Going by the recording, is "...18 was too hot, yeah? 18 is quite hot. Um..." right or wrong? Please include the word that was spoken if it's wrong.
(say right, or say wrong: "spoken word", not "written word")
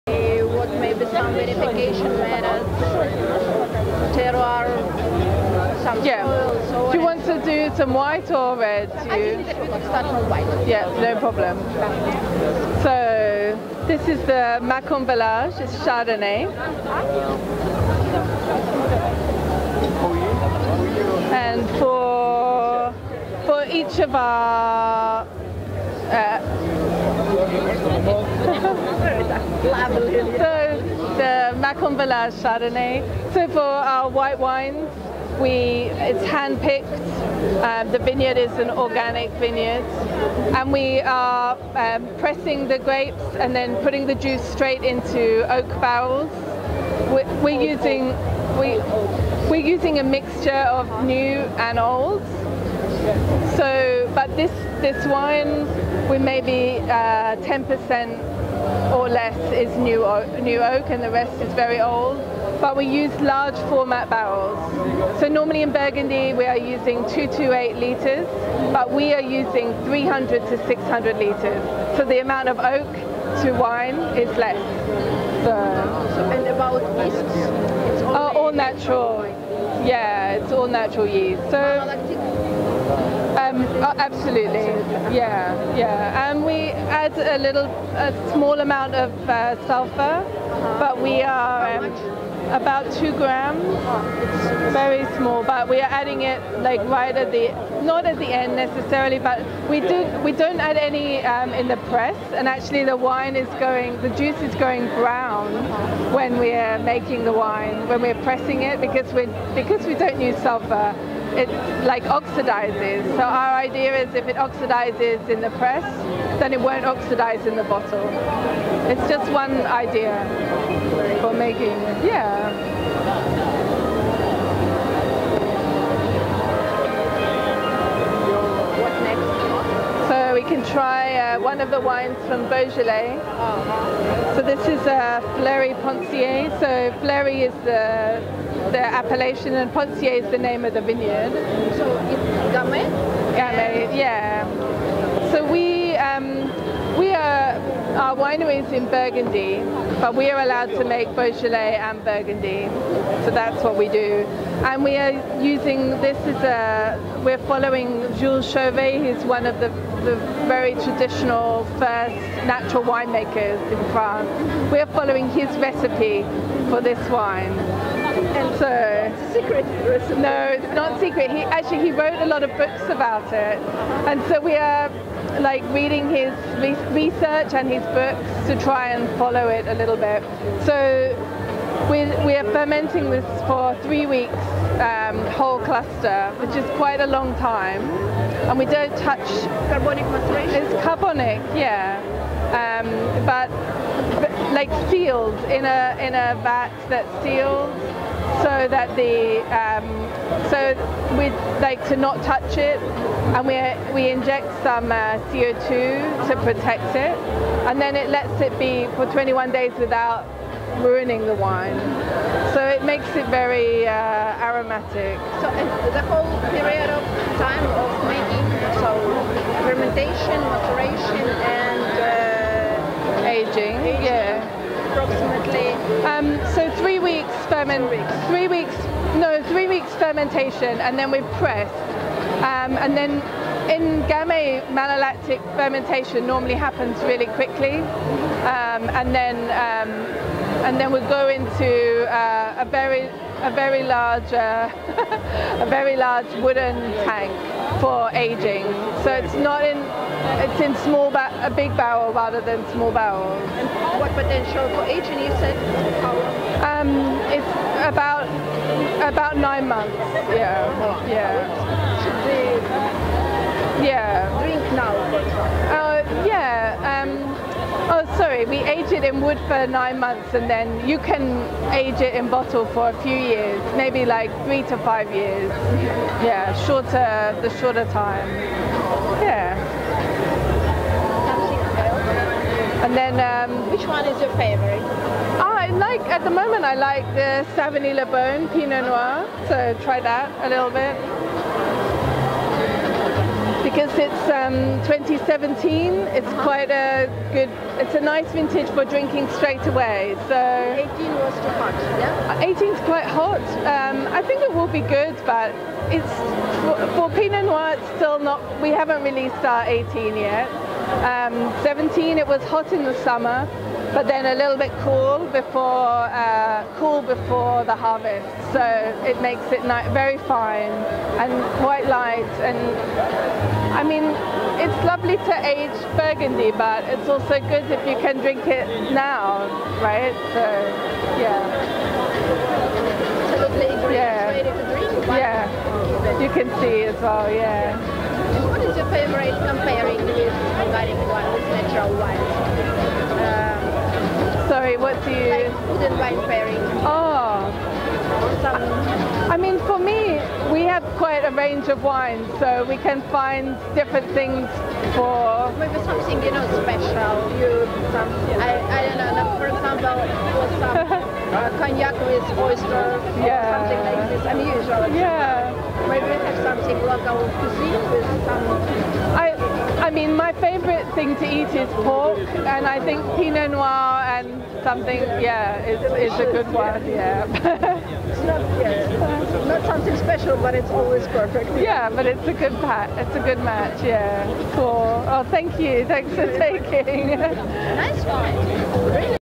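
right.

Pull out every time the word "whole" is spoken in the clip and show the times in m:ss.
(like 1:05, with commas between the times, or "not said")
3:05, 3:36.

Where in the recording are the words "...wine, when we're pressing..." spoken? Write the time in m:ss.
1:47.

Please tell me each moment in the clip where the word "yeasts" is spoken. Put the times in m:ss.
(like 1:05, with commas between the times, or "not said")
1:16, 1:21.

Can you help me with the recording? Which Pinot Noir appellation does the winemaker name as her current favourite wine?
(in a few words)
Savigny-lès-Beaune.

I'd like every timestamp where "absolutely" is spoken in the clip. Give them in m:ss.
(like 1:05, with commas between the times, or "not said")
1:24.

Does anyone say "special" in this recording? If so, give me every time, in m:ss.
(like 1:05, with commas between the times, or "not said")
5:56, 6:19.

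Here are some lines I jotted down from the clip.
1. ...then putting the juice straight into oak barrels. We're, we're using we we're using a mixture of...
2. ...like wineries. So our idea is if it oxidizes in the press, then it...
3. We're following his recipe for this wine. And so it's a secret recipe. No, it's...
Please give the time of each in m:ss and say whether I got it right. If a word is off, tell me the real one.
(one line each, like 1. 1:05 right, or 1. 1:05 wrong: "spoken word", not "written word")
1. 0:43 right
2. 1:51 wrong: "oxidizes", not "wineries"
3. 2:44 right.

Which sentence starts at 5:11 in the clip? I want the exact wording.
Um, 17, it was hot in the summer but then a little bit cool before uh, cool before the harvest.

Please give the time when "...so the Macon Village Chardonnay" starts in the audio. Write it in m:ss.
0:29.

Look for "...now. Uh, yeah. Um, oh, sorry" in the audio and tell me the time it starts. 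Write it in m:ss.
4:24.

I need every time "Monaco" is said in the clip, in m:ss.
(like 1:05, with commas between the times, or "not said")
not said.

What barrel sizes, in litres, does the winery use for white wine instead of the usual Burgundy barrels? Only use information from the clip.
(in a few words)
300 to 600 litres.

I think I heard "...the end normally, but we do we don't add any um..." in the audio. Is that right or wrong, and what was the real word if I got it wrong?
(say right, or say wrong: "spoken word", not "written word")
wrong: "necessarily", not "normally".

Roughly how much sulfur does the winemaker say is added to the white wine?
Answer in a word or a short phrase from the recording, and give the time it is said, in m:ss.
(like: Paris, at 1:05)
2 grams, at 1:32.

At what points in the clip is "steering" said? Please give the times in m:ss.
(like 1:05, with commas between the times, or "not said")
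not said.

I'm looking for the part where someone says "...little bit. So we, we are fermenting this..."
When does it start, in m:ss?
2:59.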